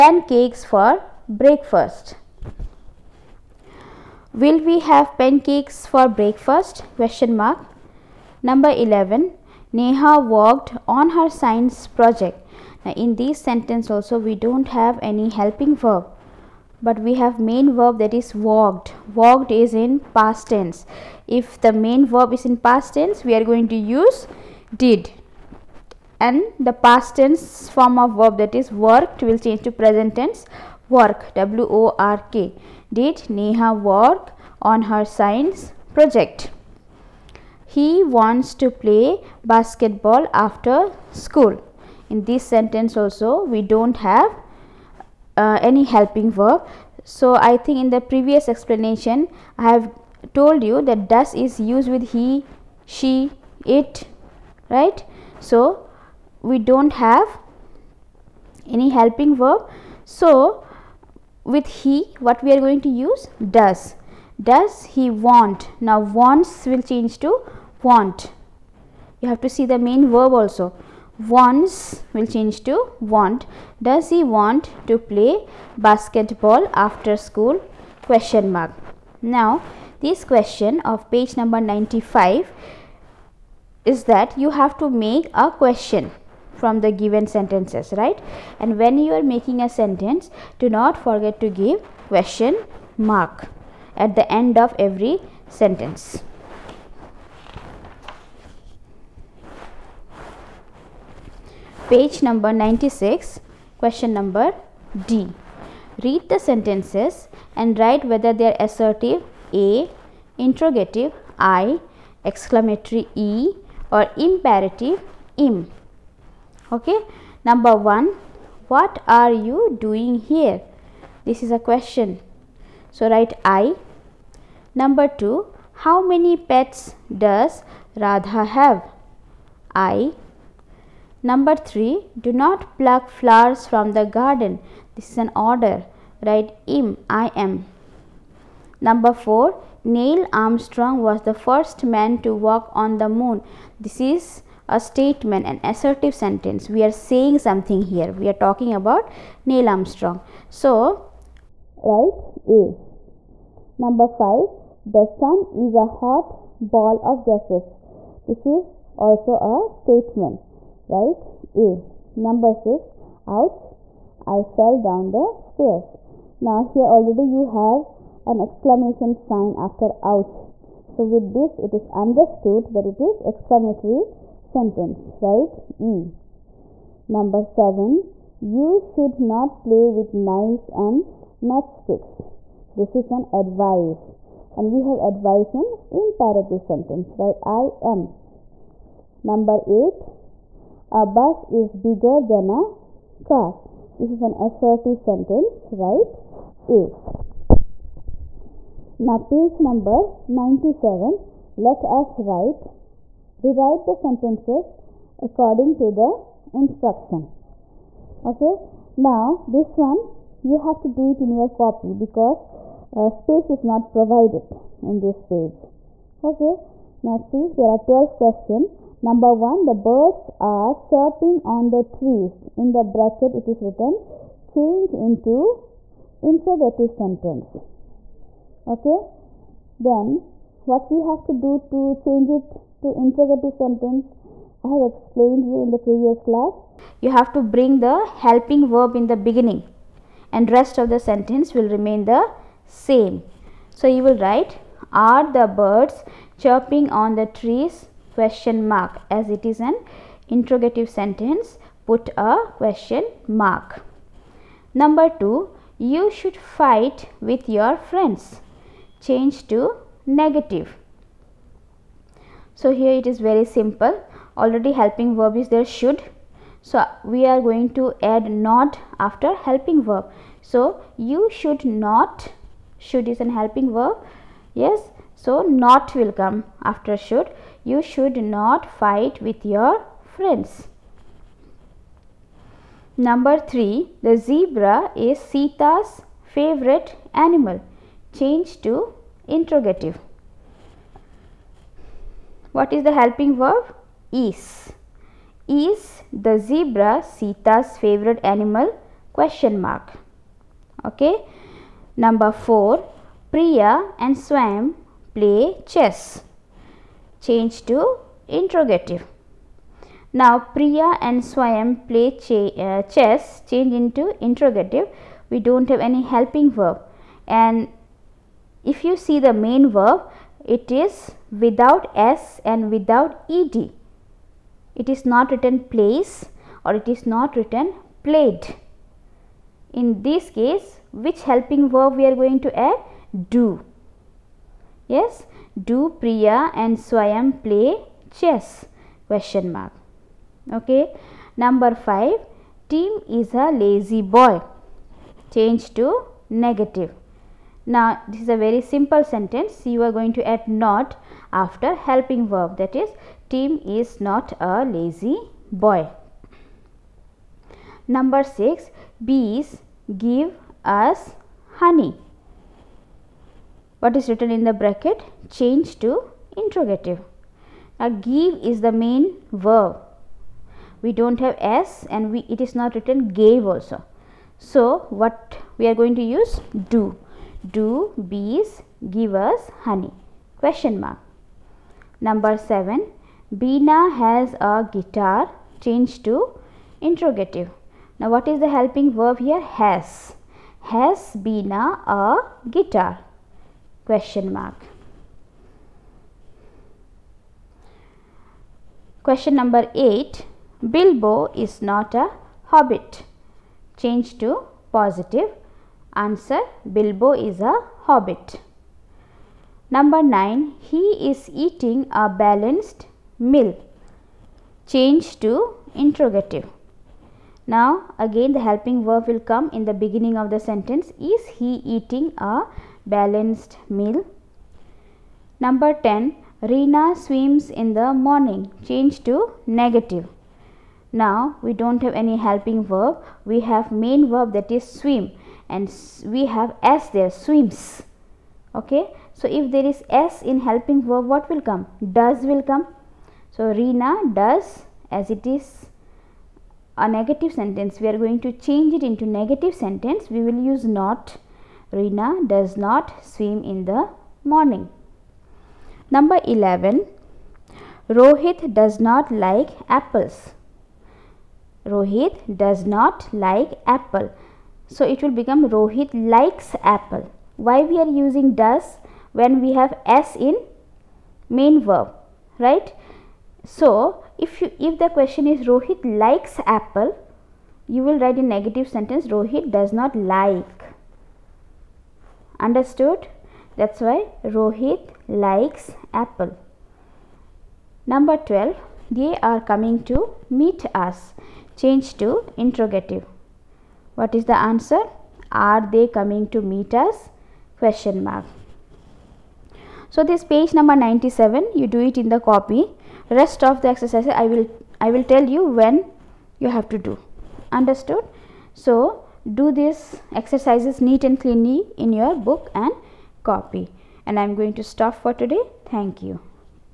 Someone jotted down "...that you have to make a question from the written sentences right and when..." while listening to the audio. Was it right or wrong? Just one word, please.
wrong.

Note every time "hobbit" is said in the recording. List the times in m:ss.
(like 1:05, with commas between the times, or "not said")
6:42, 6:47.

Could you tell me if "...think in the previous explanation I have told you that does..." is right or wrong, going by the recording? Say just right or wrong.
right.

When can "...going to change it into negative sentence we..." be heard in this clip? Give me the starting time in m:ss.
7:27.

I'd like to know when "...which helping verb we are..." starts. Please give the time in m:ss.
5:30.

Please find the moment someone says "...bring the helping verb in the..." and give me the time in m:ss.
3:57.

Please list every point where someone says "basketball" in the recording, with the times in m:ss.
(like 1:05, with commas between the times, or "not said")
0:39, 1:15.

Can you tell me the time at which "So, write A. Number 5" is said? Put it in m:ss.
2:30.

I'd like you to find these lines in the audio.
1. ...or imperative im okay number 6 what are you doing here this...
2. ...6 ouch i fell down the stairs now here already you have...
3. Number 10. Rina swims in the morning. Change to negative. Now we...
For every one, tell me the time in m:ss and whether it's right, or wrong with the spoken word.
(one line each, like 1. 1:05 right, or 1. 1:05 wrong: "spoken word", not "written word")
1. 1:53 wrong: "1", not "6"
2. 2:42 right
3. 7:05 right.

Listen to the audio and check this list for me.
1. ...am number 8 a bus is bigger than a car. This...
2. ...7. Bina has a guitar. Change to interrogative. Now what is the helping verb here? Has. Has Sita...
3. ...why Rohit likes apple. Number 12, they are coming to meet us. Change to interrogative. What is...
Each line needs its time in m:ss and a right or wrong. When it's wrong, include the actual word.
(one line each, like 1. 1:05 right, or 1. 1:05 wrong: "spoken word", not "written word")
1. 3:07 right
2. 6:22 wrong: "Bina", not "Sita"
3. 8:03 right.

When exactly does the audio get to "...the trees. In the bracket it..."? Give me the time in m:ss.
3:41.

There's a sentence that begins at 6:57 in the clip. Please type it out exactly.
Now again the helping verb will come in the beginning of the sentence.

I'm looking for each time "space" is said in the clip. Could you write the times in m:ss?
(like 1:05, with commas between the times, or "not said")
3:33.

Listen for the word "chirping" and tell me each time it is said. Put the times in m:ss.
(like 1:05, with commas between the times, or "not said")
3:40, 4:06.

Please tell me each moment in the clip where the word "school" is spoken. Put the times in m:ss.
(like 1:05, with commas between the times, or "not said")
0:41, 1:17.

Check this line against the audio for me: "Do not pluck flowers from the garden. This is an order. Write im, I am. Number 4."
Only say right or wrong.
right.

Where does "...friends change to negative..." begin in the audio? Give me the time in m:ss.
4:17.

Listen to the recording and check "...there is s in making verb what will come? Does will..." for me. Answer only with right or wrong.
wrong.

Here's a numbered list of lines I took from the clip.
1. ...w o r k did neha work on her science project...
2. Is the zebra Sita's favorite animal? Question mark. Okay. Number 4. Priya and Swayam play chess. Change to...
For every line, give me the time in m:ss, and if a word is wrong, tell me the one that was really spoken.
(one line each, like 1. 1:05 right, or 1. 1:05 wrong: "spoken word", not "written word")
1. 0:31 right
2. 4:55 right.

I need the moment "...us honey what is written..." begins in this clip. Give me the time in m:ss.
6:00.